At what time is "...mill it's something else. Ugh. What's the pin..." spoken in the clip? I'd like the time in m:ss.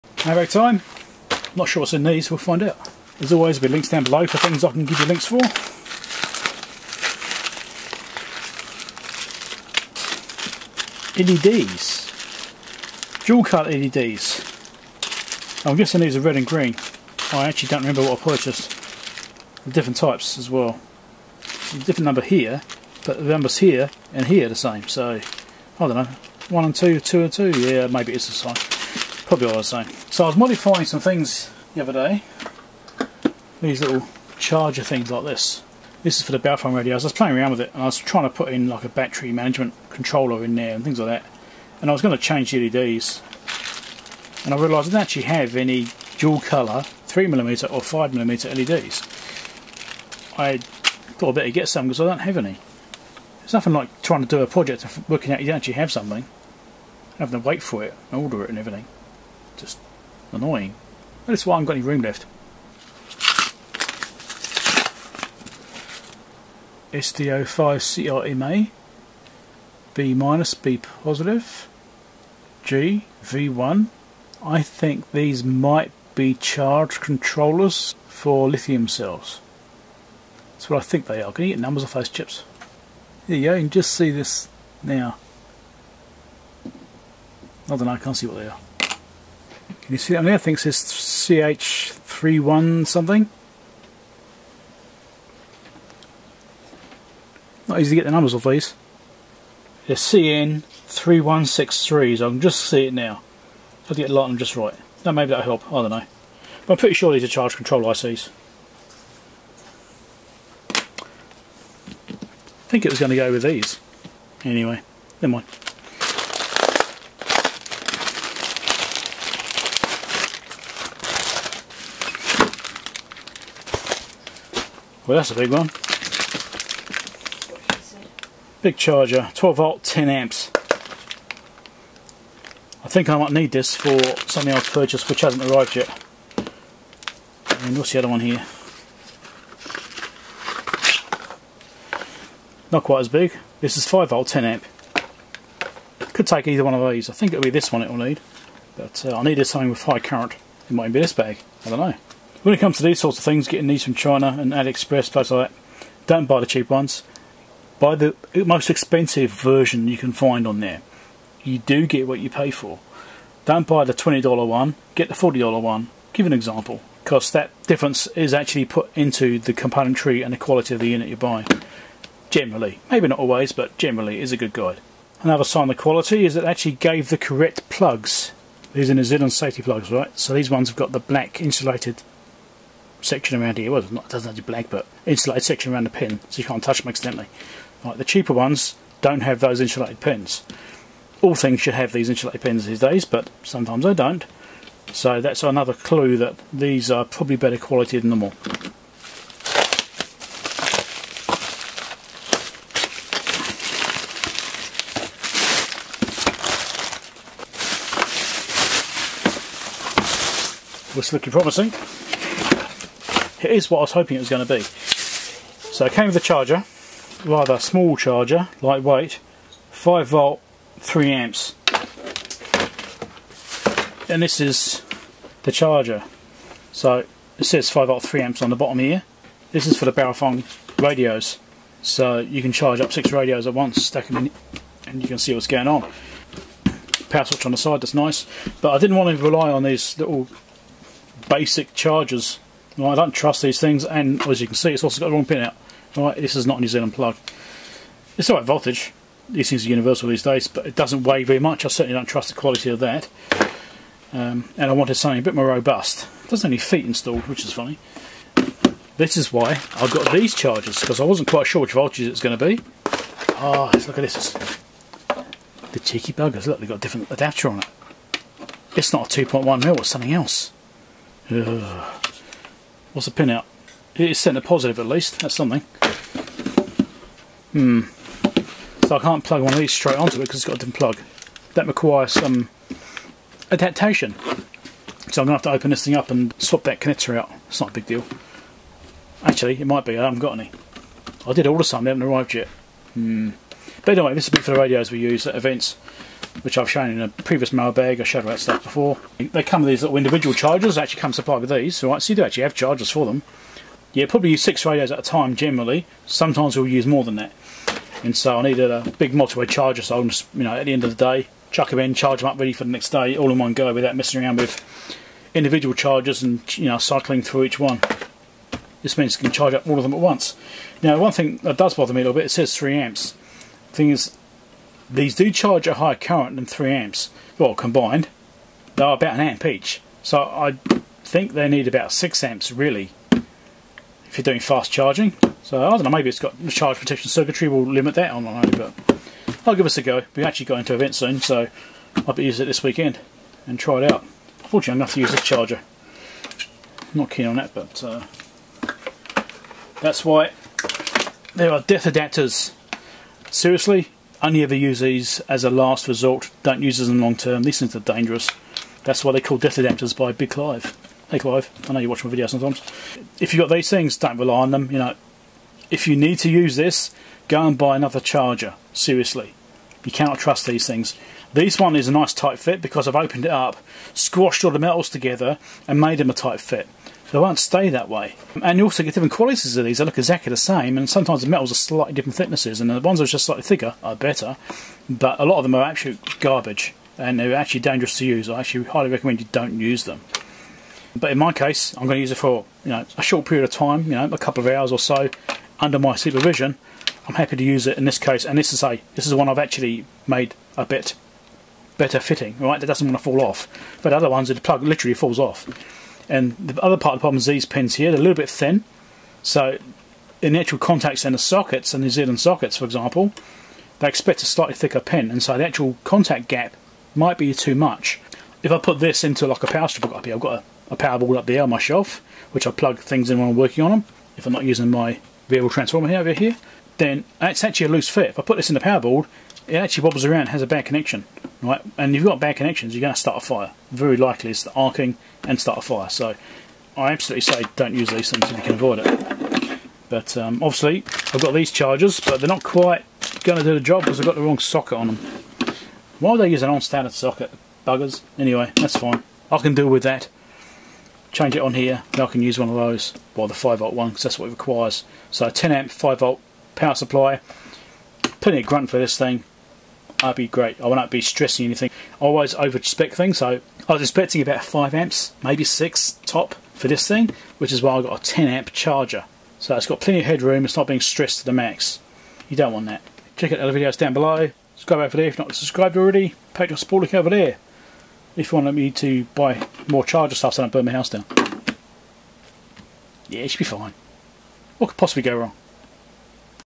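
4:29.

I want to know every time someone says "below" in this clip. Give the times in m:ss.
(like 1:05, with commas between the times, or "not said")
0:04, 7:53.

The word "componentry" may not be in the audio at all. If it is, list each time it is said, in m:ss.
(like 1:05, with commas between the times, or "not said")
2:49.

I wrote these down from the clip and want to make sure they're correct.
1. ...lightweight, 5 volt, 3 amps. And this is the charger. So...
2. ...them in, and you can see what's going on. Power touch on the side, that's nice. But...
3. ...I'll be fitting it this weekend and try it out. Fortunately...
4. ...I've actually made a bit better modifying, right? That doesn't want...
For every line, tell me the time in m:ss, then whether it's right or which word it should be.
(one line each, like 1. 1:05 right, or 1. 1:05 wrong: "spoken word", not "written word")
1. 3:38 right
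2. 3:54 wrong: "switch", not "touch"
3. 5:42 wrong: "using", not "fitting"
4. 6:39 wrong: "fitting", not "modifying".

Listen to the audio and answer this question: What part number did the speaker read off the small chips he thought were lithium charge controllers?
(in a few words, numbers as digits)
CN3163.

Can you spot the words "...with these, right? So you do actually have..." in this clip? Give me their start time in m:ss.
5:01.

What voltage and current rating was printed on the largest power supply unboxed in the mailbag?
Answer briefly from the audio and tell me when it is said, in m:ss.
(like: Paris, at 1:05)
12 volt, 10 amps, at 2:09.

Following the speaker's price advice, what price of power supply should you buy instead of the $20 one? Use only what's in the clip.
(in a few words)
$40.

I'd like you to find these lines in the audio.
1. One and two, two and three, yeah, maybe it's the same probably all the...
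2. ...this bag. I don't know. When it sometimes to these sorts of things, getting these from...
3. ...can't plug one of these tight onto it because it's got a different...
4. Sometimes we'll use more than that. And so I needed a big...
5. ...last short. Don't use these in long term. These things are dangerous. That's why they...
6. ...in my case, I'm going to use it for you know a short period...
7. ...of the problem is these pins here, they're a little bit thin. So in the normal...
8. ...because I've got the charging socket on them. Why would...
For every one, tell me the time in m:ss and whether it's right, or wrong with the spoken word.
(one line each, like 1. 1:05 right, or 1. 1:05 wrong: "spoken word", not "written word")
1. 0:26 wrong: "two", not "three"
2. 2:31 wrong: "comes", not "sometimes"
3. 4:38 wrong: "straight", not "tight"
4. 5:06 right
5. 5:55 wrong: "resort", not "short"
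6. 6:31 right
7. 6:46 wrong: "actual", not "normal"
8. 7:23 wrong: "wrong", not "charging".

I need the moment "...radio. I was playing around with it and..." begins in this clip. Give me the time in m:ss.
0:36.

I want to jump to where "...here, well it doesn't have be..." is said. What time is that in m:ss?
3:03.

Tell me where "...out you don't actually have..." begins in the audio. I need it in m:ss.
0:55.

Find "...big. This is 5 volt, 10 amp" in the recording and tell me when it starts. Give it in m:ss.
2:23.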